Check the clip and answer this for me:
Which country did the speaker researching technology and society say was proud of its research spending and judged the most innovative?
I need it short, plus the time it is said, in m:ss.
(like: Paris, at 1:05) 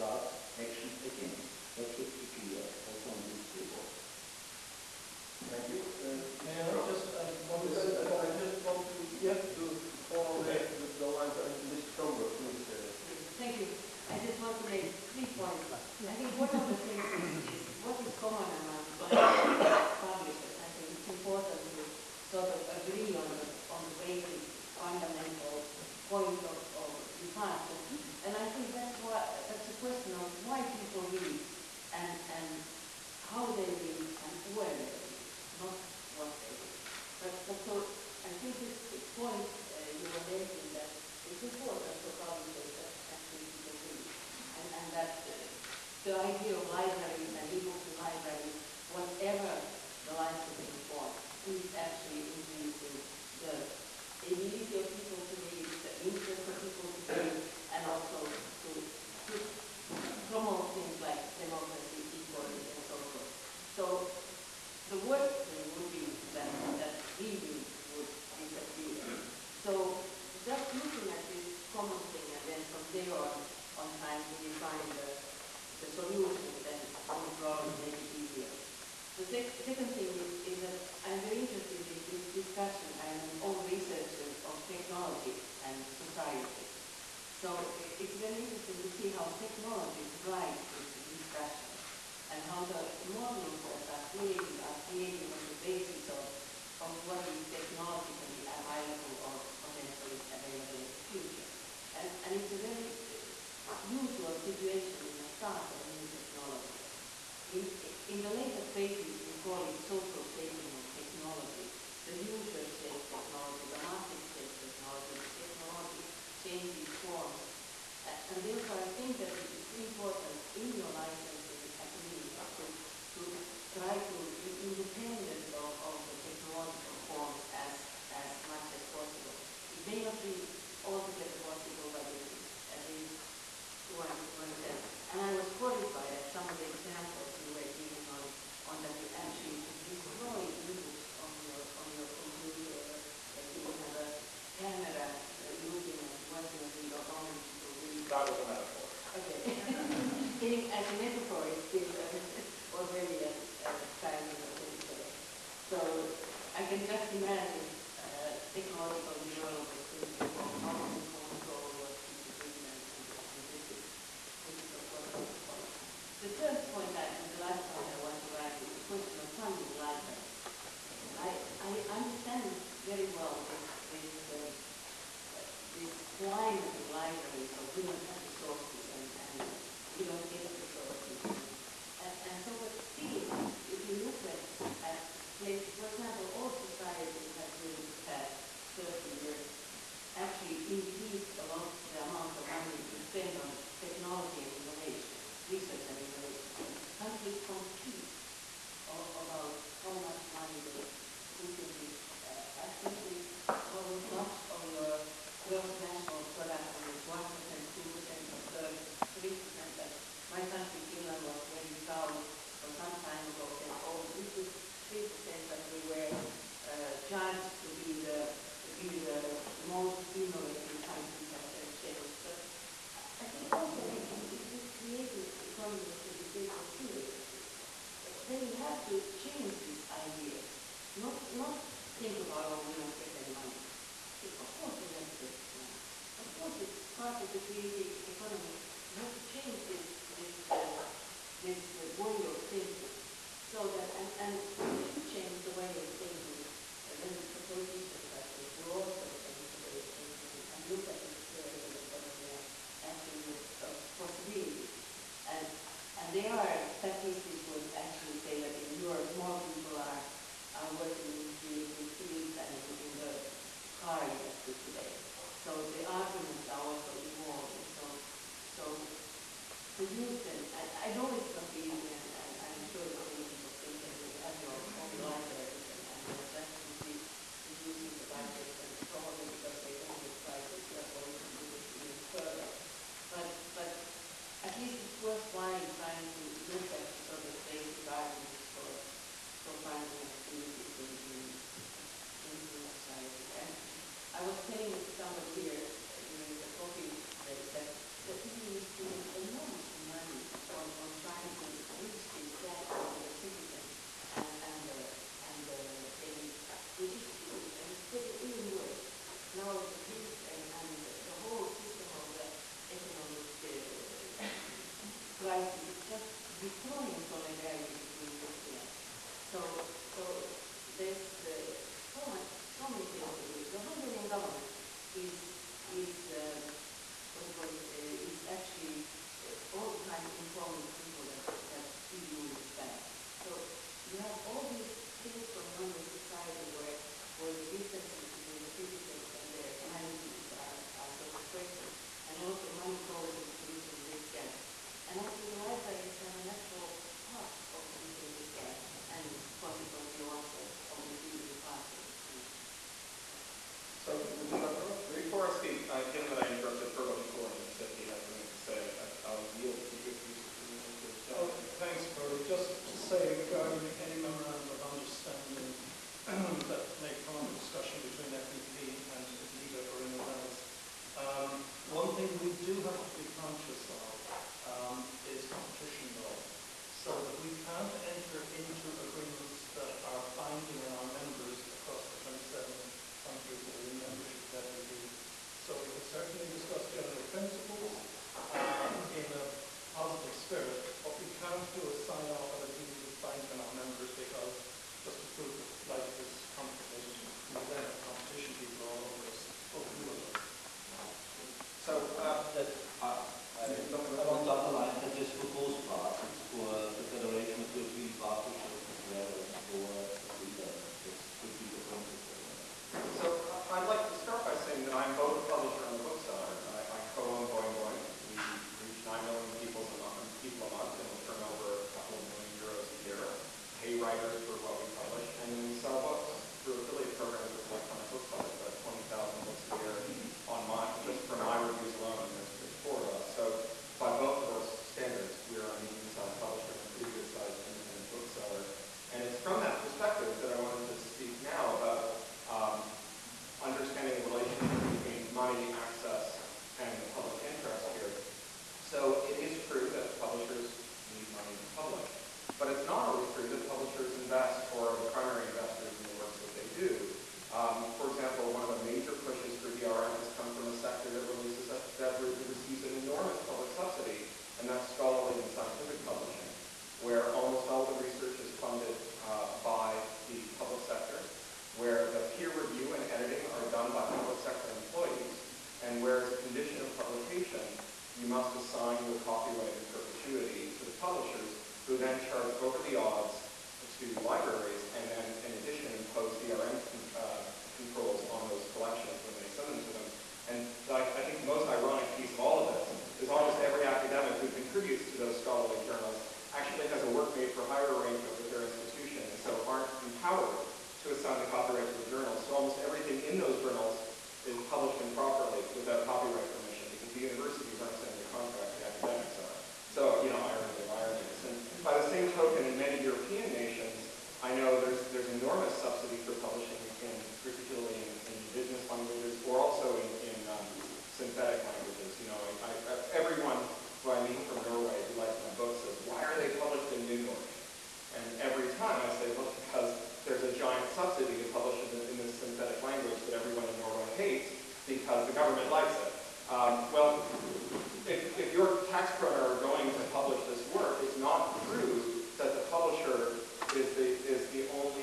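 Finland, at 3:30.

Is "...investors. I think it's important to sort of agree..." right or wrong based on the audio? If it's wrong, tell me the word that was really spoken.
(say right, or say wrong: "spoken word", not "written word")
wrong: "publishers", not "investors".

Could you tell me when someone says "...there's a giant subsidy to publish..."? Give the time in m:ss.
8:50.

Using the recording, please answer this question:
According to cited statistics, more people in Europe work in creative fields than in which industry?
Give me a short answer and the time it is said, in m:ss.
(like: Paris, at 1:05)
car industry, at 4:23.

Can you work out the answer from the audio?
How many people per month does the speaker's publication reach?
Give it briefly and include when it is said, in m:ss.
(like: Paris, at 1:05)
9 million, at 6:58.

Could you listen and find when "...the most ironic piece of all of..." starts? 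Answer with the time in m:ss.
8:11.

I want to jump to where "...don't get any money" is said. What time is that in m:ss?
3:52.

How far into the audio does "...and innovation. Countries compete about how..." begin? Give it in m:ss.
3:15.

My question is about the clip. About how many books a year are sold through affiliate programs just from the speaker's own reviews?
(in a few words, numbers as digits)
20,000.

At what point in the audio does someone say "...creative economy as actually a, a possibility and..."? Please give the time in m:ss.
4:11.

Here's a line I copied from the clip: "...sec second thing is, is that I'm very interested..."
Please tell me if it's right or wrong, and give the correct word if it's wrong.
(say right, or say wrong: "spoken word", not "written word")
right.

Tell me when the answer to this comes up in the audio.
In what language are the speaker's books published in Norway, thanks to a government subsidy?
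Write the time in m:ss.
8:46.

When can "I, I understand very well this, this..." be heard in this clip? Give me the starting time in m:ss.
2:51.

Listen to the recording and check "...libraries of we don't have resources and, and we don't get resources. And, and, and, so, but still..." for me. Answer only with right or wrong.
right.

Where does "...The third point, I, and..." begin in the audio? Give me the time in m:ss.
2:46.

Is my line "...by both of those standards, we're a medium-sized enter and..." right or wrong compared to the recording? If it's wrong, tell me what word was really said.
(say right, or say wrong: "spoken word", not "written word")
wrong: "publisher", not "enter".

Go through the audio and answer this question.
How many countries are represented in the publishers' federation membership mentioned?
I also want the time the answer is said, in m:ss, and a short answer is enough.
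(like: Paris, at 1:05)
27, at 6:22.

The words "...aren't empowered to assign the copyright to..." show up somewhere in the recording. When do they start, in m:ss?
8:19.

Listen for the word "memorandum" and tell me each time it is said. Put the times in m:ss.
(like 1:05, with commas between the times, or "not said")
6:03.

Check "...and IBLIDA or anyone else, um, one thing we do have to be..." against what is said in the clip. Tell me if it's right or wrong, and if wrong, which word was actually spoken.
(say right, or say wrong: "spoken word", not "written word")
right.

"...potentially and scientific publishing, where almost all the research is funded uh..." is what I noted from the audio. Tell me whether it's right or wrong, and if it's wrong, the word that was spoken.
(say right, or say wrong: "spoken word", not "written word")
wrong: "scholarly", not "potentially".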